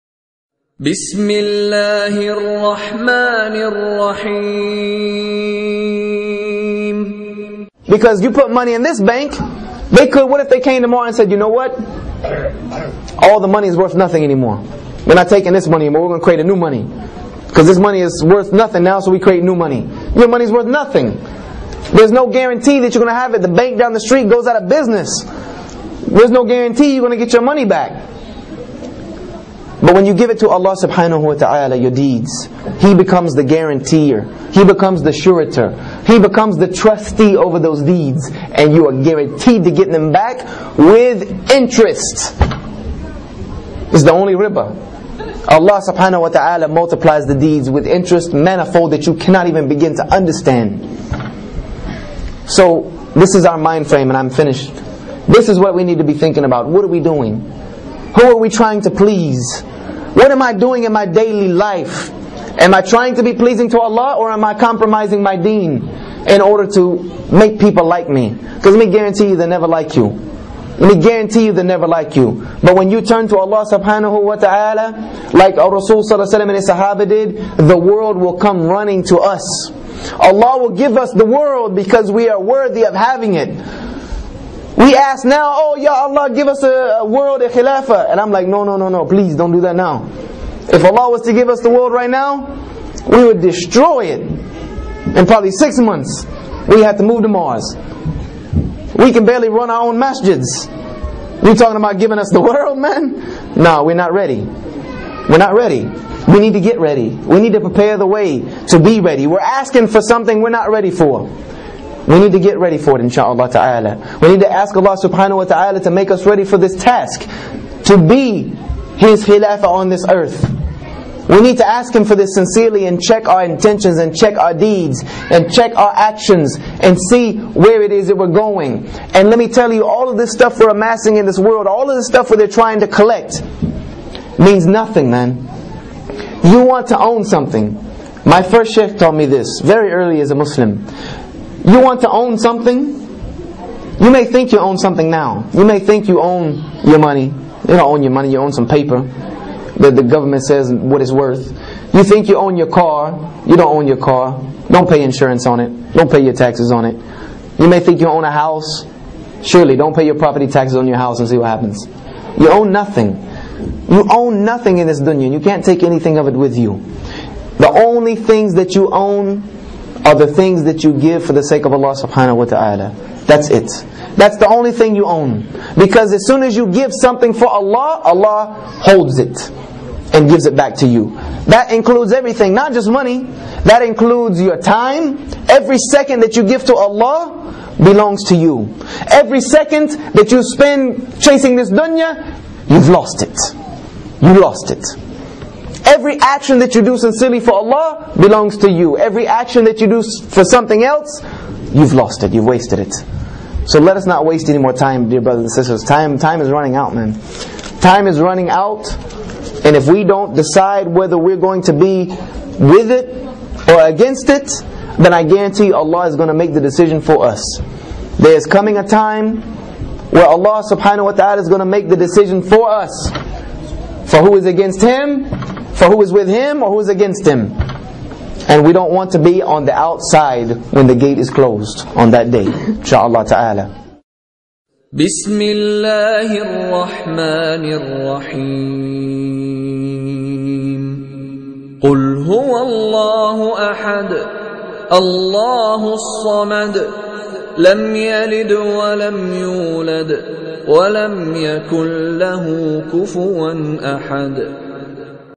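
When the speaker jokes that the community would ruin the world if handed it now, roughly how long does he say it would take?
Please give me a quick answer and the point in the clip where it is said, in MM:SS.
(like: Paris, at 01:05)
6 months, at 01:35.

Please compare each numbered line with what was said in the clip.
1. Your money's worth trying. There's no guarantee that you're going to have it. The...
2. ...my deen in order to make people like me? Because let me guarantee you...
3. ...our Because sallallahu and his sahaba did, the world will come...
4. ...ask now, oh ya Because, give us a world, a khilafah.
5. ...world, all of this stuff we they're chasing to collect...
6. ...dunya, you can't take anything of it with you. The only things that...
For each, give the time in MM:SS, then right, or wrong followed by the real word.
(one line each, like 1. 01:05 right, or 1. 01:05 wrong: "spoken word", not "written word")
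1. 00:20 wrong: "nothing", not "trying"
2. 01:05 right
3. 01:15 wrong: "Rasul", not "Because"
4. 01:24 wrong: "Allah", not "Because"
5. 02:11 wrong: "trying", not "chasing"
6. 02:44 right.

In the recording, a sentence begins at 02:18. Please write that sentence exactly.
My first sheikh taught me this very early as a Muslim.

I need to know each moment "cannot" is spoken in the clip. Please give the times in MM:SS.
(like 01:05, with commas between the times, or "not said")
00:49.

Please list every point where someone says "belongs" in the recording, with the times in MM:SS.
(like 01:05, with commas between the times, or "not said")
03:07, 03:18.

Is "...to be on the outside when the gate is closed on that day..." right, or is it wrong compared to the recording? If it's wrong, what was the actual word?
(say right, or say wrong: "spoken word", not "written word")
right.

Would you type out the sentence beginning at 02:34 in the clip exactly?
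Don't pay insurance on it, don't pay your taxes on it.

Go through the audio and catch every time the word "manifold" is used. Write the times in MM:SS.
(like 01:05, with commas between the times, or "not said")
00:48.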